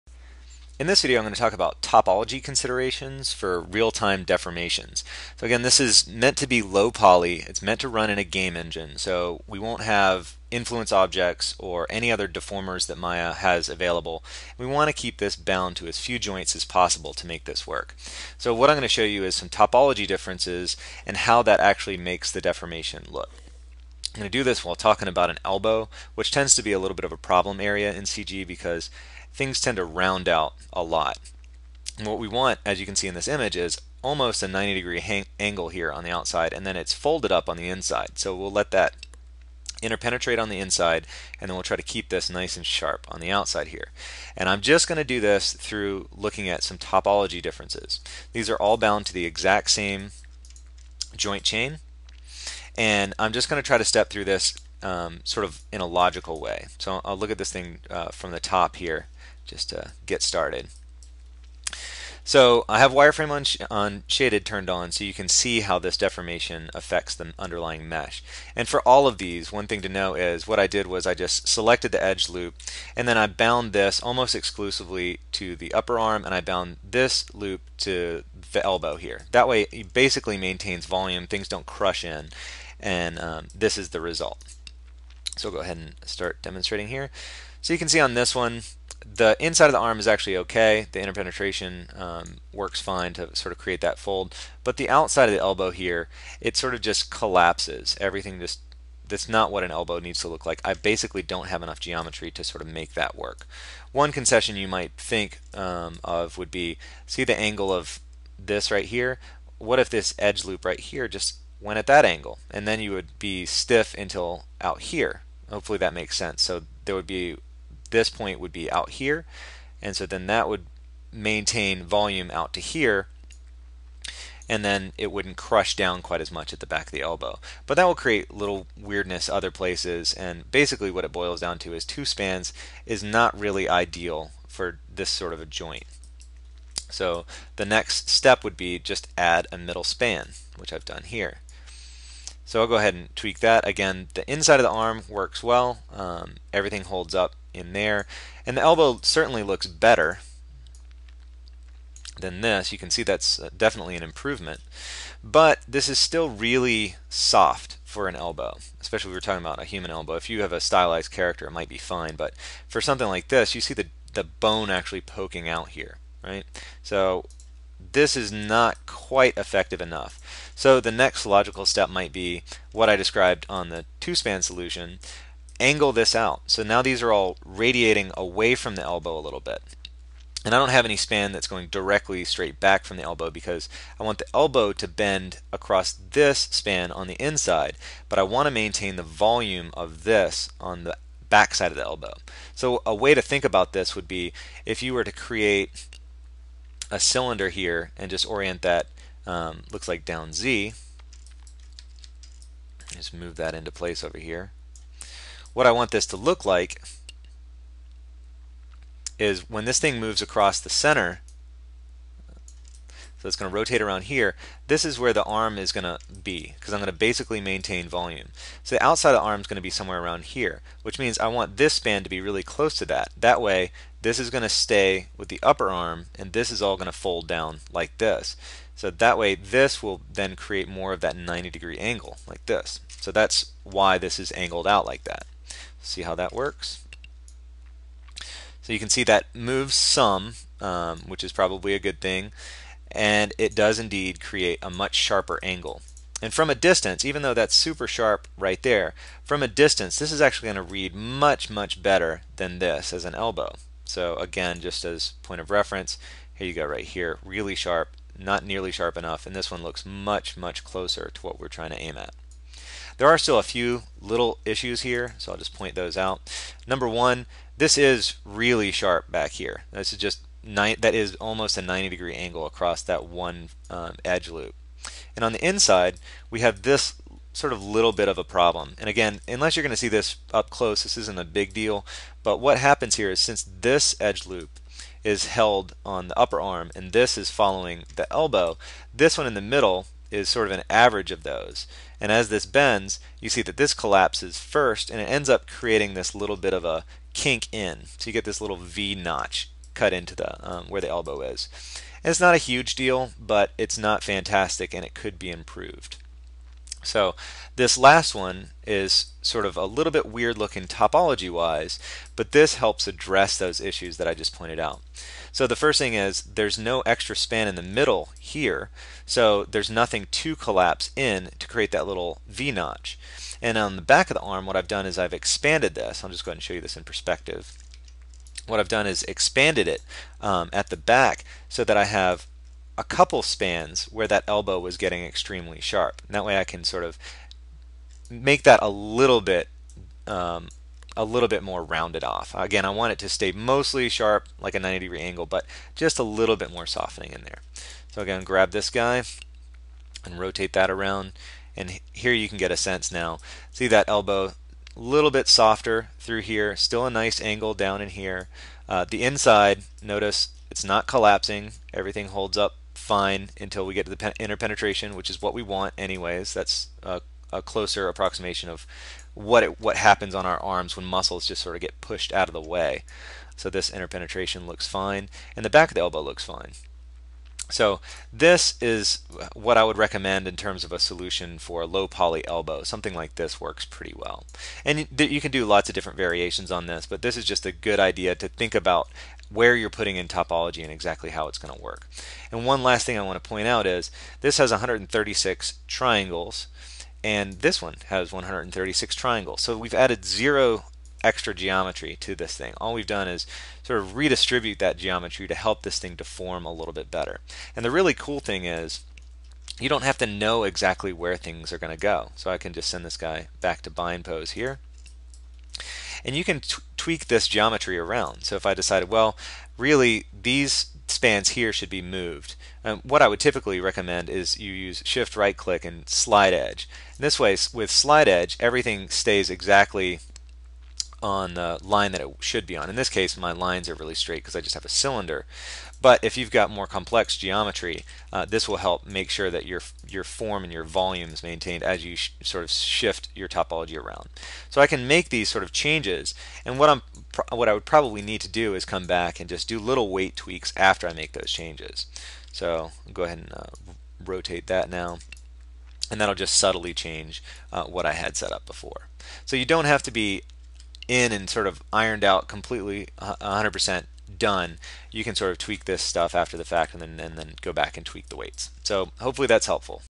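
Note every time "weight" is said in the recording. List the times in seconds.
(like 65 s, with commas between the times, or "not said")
449 s, 468 s.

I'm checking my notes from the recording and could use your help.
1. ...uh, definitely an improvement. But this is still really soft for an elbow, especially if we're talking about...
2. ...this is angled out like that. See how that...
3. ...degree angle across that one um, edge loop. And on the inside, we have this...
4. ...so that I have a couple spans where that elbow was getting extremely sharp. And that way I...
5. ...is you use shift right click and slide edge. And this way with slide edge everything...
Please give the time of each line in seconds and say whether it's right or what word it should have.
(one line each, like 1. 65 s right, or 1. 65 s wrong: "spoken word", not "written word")
1. 153 s right
2. 233 s right
3. 271 s right
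4. 331 s right
5. 424 s right.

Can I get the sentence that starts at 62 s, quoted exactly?
So I have wireframe on, sh on shaded turned on so you can see how this deformation affects the underlying mesh.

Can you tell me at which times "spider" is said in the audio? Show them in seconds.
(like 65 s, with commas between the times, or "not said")
not said.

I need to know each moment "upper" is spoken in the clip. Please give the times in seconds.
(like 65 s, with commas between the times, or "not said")
75 s, 225 s, 286 s.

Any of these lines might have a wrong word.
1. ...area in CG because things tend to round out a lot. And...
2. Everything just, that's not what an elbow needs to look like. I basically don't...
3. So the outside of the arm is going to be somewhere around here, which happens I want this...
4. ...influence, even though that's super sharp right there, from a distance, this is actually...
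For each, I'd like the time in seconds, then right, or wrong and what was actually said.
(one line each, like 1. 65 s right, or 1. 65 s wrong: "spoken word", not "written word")
1. 27 s right
2. 98 s right
3. 218 s wrong: "means", not "happens"
4. 246 s wrong: "distance", not "influence".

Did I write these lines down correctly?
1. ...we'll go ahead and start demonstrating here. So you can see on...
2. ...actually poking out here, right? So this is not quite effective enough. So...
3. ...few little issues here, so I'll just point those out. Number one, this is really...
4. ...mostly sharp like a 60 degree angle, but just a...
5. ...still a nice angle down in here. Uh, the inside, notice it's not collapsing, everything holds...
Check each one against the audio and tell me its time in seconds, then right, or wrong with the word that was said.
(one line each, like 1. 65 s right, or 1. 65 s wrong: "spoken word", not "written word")
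1. 85 s right
2. 164 s right
3. 263 s right
4. 343 s wrong: "90", not "60"
5. 356 s right.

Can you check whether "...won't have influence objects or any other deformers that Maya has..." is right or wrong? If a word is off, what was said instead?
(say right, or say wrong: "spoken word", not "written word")
right.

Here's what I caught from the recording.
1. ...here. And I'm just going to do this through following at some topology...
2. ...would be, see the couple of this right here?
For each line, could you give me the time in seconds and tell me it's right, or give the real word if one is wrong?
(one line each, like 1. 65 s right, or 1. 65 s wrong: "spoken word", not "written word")
1. 43 s wrong: "looking", not "following"
2. 106 s wrong: "angle", not "couple".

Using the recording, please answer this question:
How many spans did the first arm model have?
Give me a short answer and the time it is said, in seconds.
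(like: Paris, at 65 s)
2, at 131 s.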